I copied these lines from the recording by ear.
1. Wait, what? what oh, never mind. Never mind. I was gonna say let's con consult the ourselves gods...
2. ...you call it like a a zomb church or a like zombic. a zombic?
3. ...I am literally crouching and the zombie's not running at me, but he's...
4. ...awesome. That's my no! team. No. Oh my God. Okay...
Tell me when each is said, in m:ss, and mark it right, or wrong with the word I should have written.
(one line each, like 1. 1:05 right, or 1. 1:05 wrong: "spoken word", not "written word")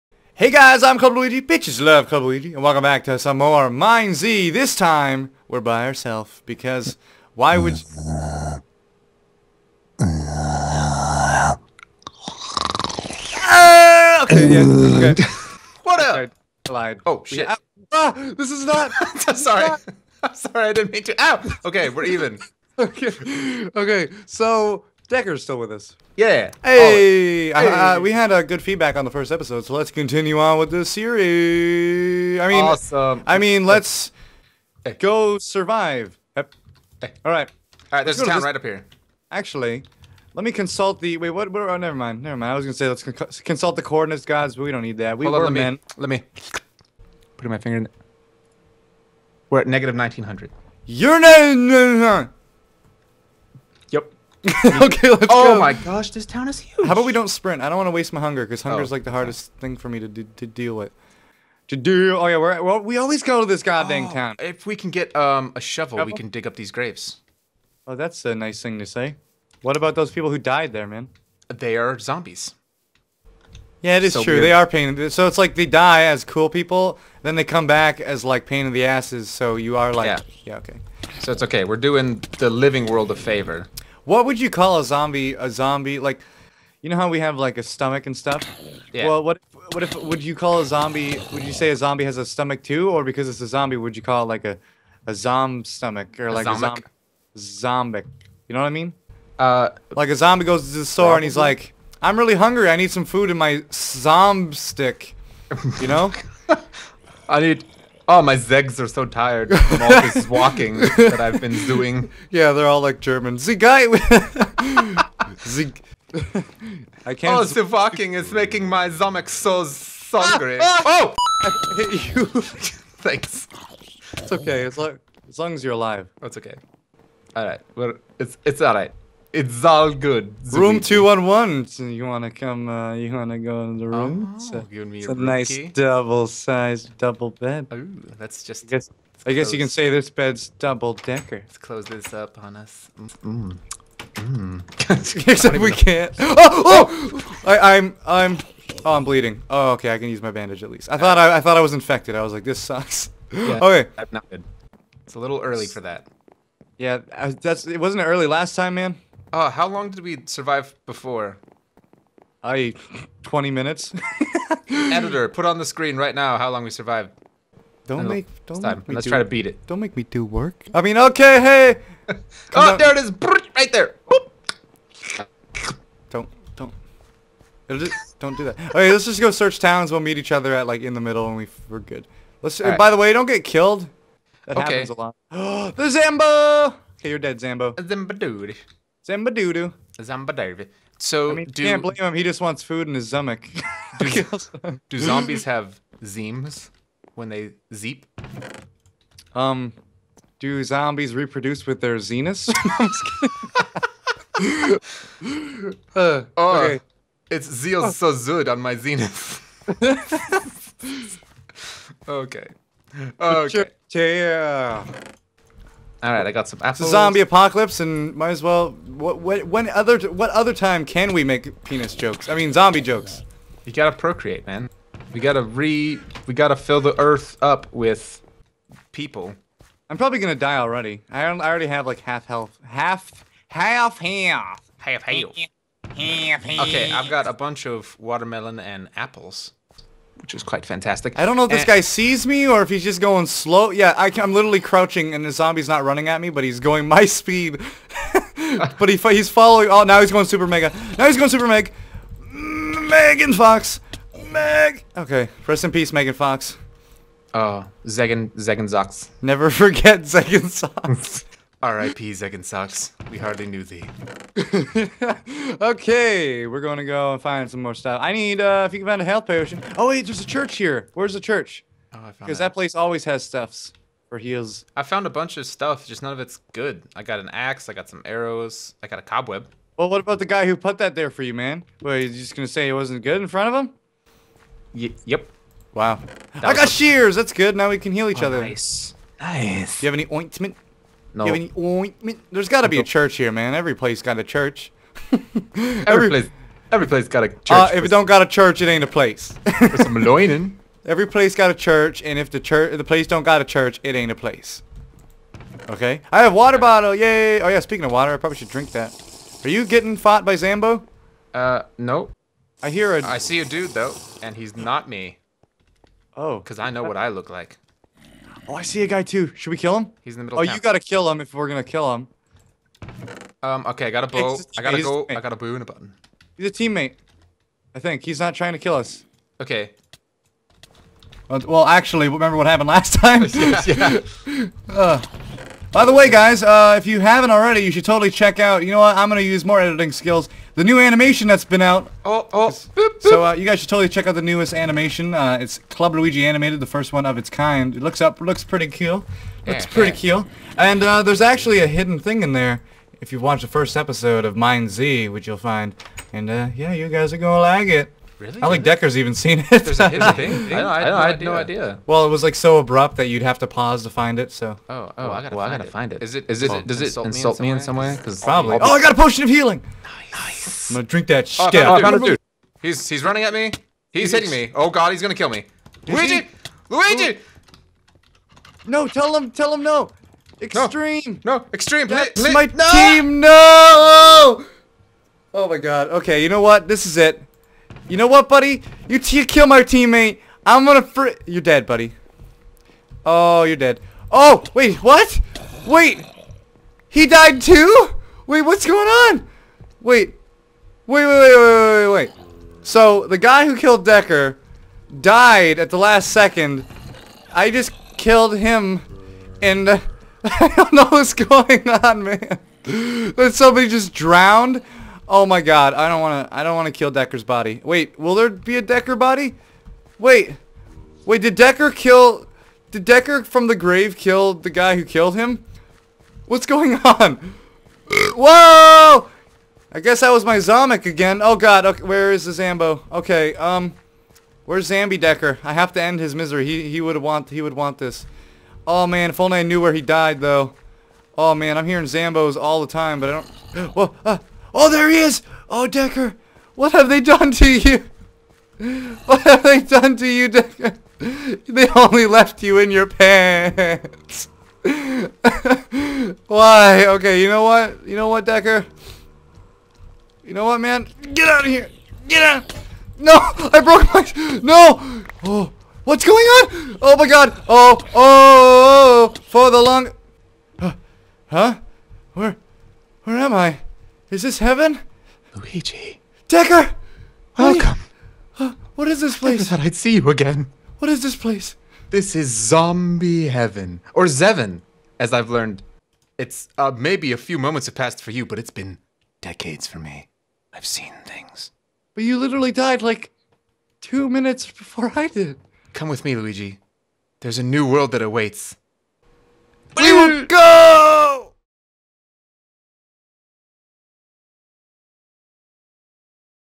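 1. 0:41 wrong: "coordinates", not "ourselves"
2. 1:33 wrong: "stomach", not "church"
3. 4:03 right
4. 6:21 wrong: "extreme", not "awesome".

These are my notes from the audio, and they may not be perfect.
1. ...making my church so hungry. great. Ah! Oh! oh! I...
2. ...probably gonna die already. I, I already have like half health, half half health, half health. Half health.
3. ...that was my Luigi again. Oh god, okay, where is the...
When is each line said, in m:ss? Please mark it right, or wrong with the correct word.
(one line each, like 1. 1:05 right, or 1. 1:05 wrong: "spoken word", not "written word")
1. 1:58 wrong: "stomach", not "church"
2. 3:49 right
3. 7:09 wrong: "Zomic", not "Luigi".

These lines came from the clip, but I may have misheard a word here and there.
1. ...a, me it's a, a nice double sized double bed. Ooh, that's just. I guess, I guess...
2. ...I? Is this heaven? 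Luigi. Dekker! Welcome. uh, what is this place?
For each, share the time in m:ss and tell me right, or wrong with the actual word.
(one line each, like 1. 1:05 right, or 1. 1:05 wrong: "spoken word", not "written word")
1. 2:14 right
2. 7:53 right.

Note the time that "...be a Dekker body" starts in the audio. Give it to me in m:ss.
6:58.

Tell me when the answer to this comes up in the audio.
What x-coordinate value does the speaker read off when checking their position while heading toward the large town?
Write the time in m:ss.
0:49.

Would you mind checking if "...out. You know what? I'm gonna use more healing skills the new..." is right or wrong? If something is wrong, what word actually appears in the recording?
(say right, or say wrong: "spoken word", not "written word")
wrong: "editing", not "healing".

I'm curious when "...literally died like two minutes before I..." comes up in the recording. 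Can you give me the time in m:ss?
8:12.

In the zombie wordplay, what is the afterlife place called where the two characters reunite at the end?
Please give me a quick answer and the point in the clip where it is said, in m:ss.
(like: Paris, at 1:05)
Zevin, at 8:04.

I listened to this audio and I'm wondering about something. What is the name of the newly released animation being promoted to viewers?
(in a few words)
Club Luigi Animated.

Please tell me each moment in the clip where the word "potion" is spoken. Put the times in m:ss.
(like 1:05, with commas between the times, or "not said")
4:29, 6:08.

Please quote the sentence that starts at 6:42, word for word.
So, the guy who killed Dekker died at the last second.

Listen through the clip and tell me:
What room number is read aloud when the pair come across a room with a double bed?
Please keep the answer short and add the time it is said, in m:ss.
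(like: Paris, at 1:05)
211, at 2:10.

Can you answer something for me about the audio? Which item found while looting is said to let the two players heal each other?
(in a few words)
Shears.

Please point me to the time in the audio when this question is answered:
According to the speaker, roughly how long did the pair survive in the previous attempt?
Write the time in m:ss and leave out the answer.
2:43.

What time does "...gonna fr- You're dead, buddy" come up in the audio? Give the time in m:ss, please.
6:30.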